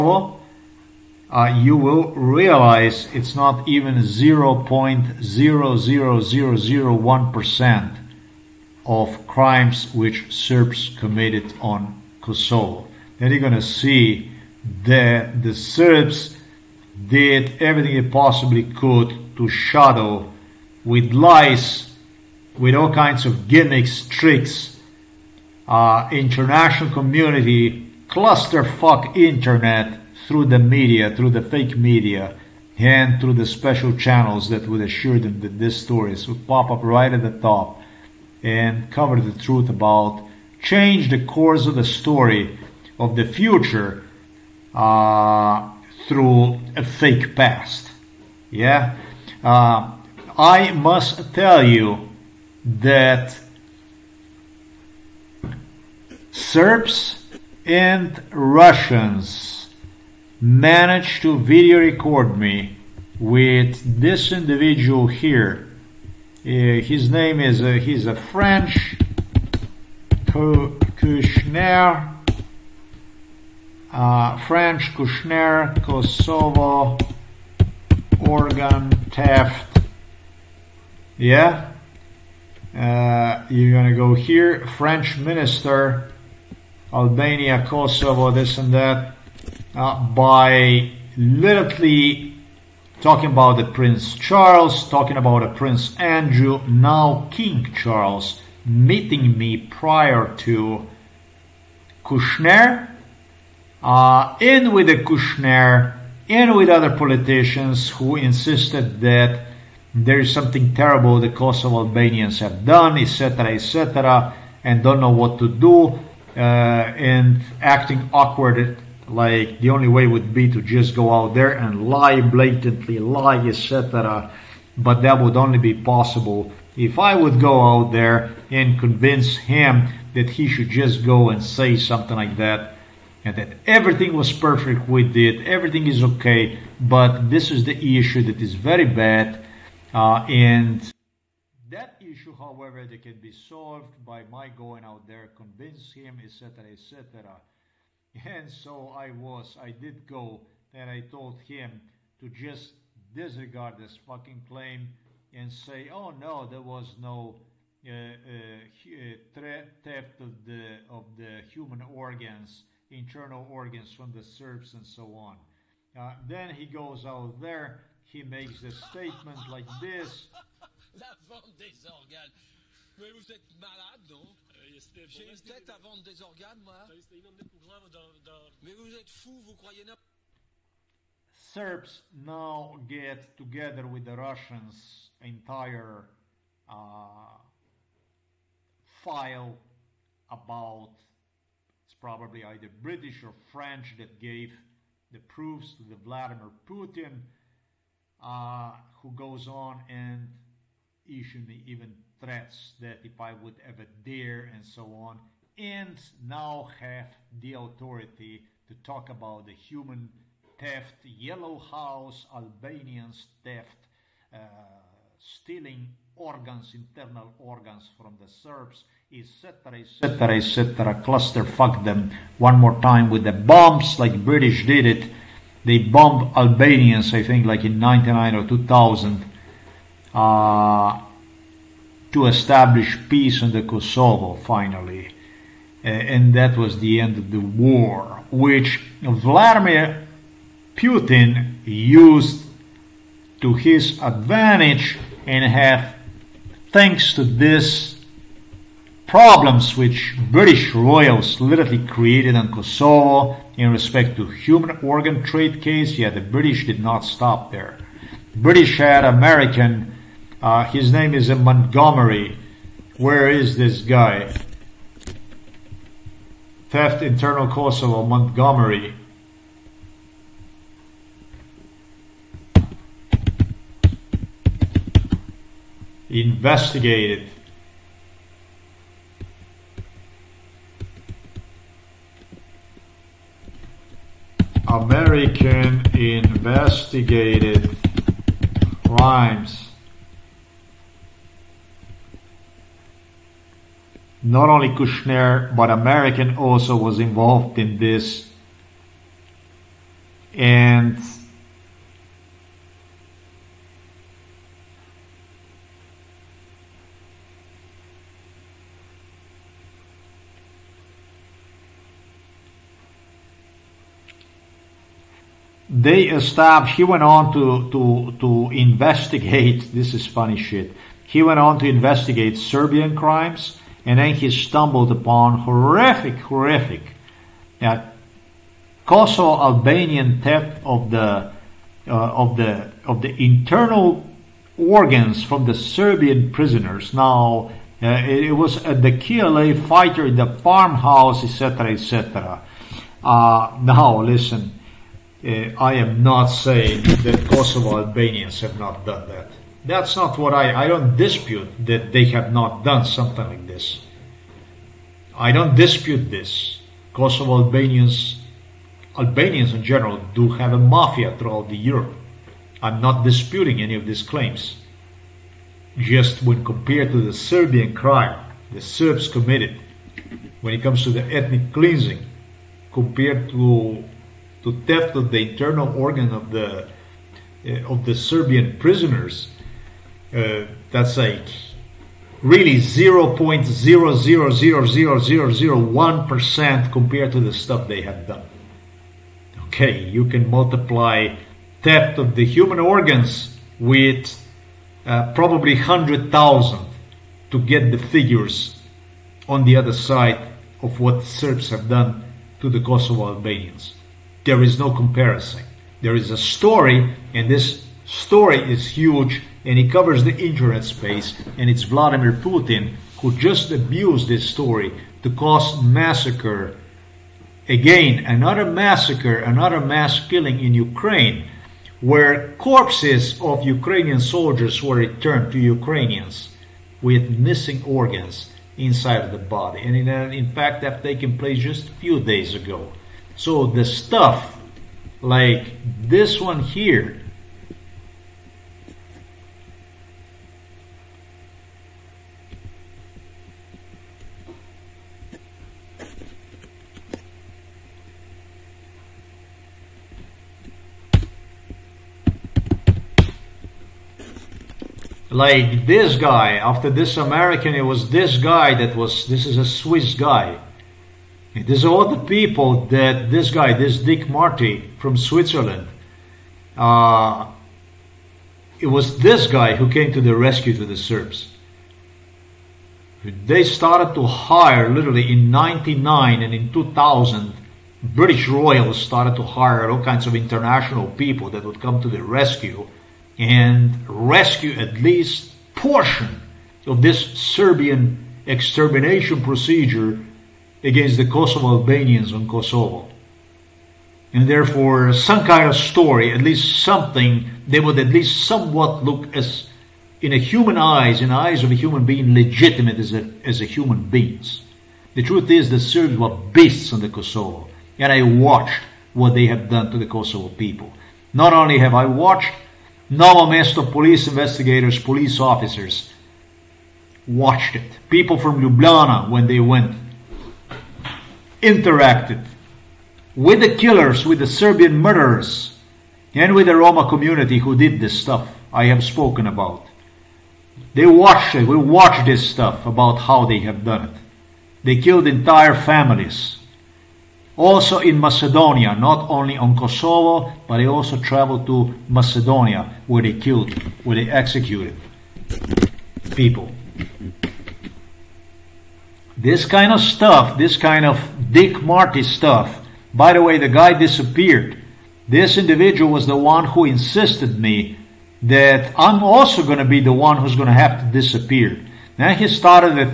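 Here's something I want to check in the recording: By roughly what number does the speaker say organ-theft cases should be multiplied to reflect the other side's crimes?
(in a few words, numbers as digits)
100,000.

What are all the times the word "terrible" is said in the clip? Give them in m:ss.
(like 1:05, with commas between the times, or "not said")
1:50.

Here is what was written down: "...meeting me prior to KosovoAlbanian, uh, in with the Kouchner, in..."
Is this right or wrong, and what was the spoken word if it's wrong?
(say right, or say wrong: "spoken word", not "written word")
wrong: "Kouchner", not "KosovoAlbanian".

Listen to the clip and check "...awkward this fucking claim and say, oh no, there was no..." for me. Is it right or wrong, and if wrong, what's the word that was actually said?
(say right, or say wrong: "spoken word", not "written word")
wrong: "disregard", not "awkward".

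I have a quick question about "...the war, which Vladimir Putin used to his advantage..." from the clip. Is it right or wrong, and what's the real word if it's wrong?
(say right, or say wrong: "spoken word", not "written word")
right.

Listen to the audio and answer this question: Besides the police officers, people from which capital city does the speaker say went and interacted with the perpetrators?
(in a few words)
Ljubljana.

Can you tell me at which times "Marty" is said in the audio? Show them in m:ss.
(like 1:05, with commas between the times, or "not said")
7:44, 9:11.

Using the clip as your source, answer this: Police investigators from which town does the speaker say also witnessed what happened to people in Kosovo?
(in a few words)
Novo Mesto.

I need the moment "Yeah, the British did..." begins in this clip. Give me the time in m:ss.
4:15.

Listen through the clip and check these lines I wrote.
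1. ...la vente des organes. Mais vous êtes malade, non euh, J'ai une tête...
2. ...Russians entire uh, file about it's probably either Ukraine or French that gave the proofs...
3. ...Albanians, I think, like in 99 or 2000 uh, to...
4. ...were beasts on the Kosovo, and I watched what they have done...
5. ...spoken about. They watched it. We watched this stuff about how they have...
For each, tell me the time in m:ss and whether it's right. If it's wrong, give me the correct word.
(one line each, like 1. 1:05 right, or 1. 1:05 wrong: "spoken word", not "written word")
1. 2:50 right
2. 3:04 wrong: "British", not "Ukraine"
3. 3:46 right
4. 8:25 right
5. 8:48 right.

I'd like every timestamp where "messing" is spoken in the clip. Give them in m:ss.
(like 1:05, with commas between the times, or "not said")
not said.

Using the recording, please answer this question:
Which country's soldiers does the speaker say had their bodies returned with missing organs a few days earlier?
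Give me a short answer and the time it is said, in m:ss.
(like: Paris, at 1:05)
Ukraine, at 7:00.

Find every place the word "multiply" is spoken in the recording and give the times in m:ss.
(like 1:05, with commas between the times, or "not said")
6:30.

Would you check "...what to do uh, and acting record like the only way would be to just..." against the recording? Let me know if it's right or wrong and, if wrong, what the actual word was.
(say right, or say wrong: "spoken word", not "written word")
wrong: "awkward", not "record".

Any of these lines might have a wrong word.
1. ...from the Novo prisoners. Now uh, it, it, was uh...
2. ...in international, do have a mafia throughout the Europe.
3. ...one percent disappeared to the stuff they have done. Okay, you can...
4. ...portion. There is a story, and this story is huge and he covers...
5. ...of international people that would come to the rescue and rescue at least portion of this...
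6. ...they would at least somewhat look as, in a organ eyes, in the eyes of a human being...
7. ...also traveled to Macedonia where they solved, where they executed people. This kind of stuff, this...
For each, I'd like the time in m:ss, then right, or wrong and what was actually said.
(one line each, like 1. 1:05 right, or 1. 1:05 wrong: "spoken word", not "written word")
1. 5:35 wrong: "Serbian", not "Novo"
2. 5:59 wrong: "general", not "international"
3. 6:25 wrong: "compared", not "disappeared"
4. 6:44 wrong: "comparison", not "portion"
5. 8:00 right
6. 8:17 wrong: "human", not "organ"
7. 9:00 wrong: "killed", not "solved".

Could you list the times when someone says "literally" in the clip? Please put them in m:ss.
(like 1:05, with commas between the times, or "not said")
1:31, 4:11, 7:54.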